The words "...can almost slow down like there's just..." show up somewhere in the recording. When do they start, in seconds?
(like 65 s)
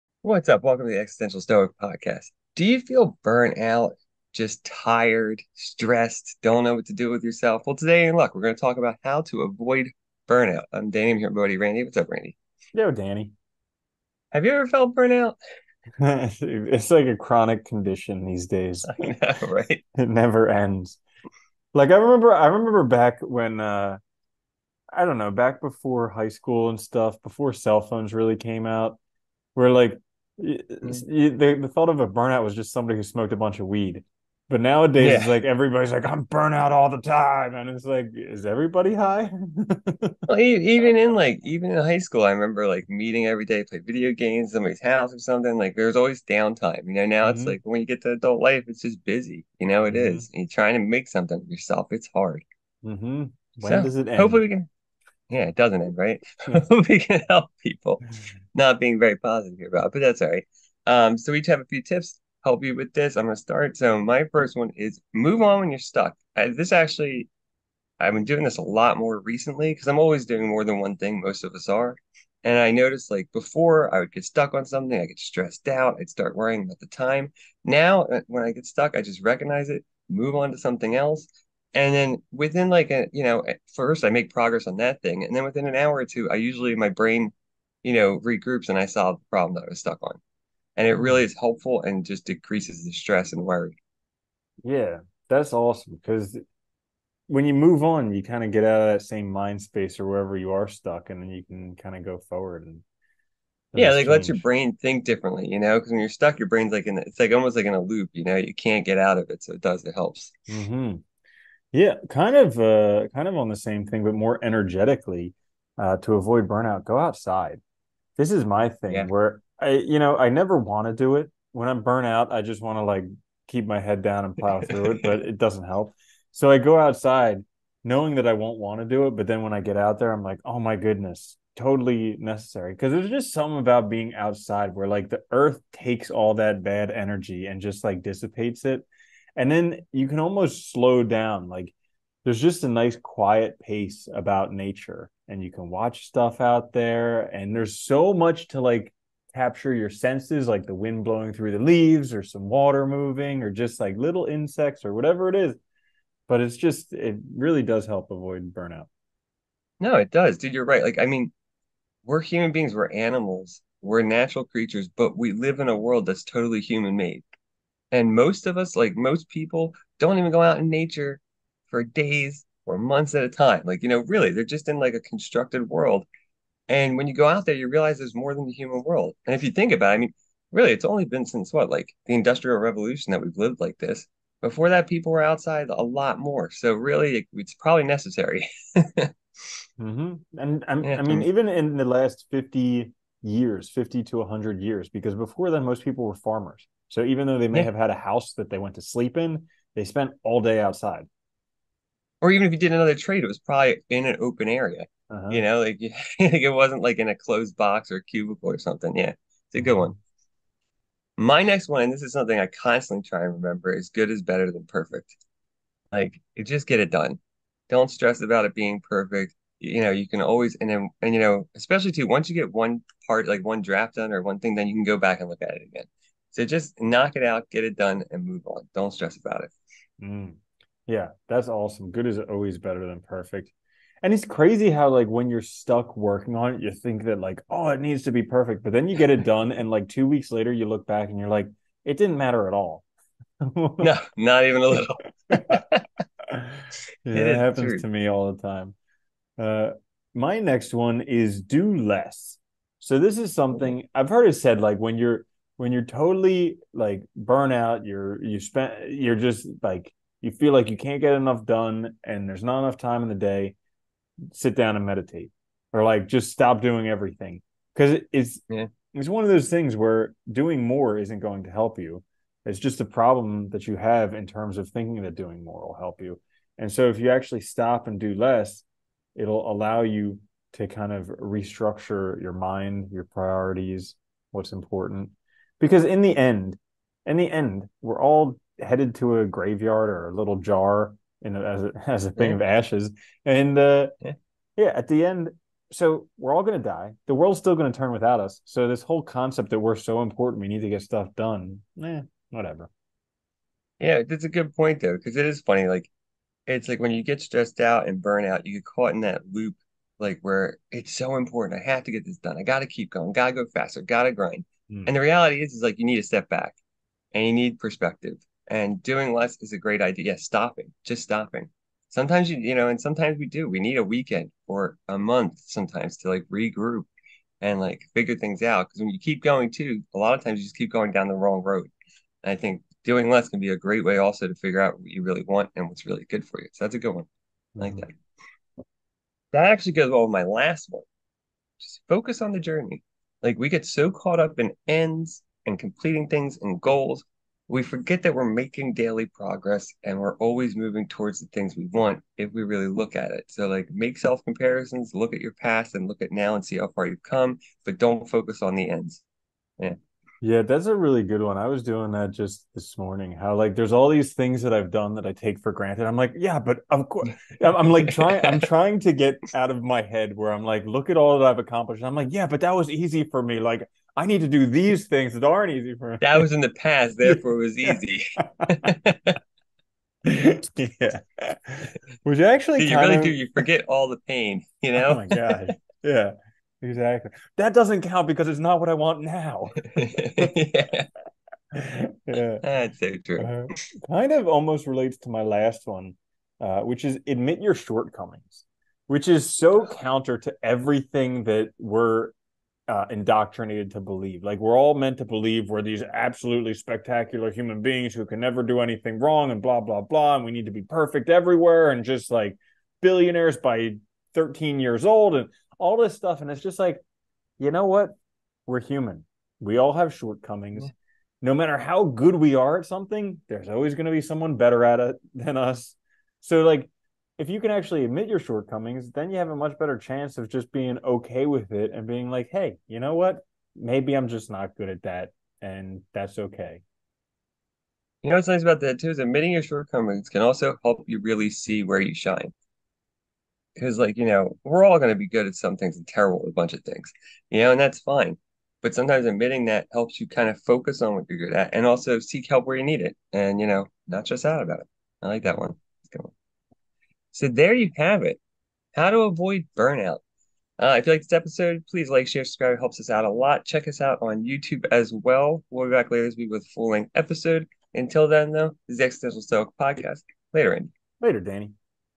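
140 s.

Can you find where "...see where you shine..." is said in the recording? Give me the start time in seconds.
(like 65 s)
441 s.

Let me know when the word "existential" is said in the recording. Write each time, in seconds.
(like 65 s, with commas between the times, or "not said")
0 s, 468 s.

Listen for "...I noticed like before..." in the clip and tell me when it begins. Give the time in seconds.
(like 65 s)
72 s.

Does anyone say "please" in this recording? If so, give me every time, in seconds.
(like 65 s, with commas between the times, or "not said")
461 s.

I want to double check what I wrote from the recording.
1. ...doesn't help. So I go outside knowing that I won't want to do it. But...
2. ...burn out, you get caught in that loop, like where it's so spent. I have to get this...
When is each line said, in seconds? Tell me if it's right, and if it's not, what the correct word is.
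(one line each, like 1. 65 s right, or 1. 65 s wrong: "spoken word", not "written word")
1. 125 s right
2. 308 s wrong: "important", not "spent".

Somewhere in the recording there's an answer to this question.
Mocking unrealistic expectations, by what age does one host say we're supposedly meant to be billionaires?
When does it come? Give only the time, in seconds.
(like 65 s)
414 s.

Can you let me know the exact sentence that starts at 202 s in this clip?
Or even if you did another trade, it was probably in an open area.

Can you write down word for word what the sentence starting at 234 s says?
And it's crazy how like when you're stuck working on it, you think that like, oh, it needs to be perfect.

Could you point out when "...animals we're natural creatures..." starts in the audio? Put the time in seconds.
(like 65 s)
162 s.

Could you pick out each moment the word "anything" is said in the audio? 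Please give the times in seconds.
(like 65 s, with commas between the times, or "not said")
408 s.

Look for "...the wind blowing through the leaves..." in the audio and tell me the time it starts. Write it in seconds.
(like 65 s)
150 s.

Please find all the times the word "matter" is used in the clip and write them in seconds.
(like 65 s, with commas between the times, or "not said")
242 s, 421 s.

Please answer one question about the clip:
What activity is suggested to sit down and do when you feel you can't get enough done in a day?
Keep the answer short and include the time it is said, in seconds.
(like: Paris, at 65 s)
meditate, at 264 s.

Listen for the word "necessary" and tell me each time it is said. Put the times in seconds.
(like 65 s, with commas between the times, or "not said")
132 s, 187 s.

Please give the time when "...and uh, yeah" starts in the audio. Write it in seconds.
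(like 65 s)
293 s.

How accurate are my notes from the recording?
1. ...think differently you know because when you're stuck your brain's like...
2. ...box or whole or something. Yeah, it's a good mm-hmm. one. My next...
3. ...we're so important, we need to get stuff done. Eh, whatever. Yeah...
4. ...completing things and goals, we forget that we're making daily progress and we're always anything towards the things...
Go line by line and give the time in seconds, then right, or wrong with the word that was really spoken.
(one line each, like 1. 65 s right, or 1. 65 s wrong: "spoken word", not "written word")
1. 104 s right
2. 207 s wrong: "cubicle", not "whole"
3. 299 s right
4. 345 s wrong: "moving", not "anything".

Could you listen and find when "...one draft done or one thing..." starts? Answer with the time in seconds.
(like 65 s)
223 s.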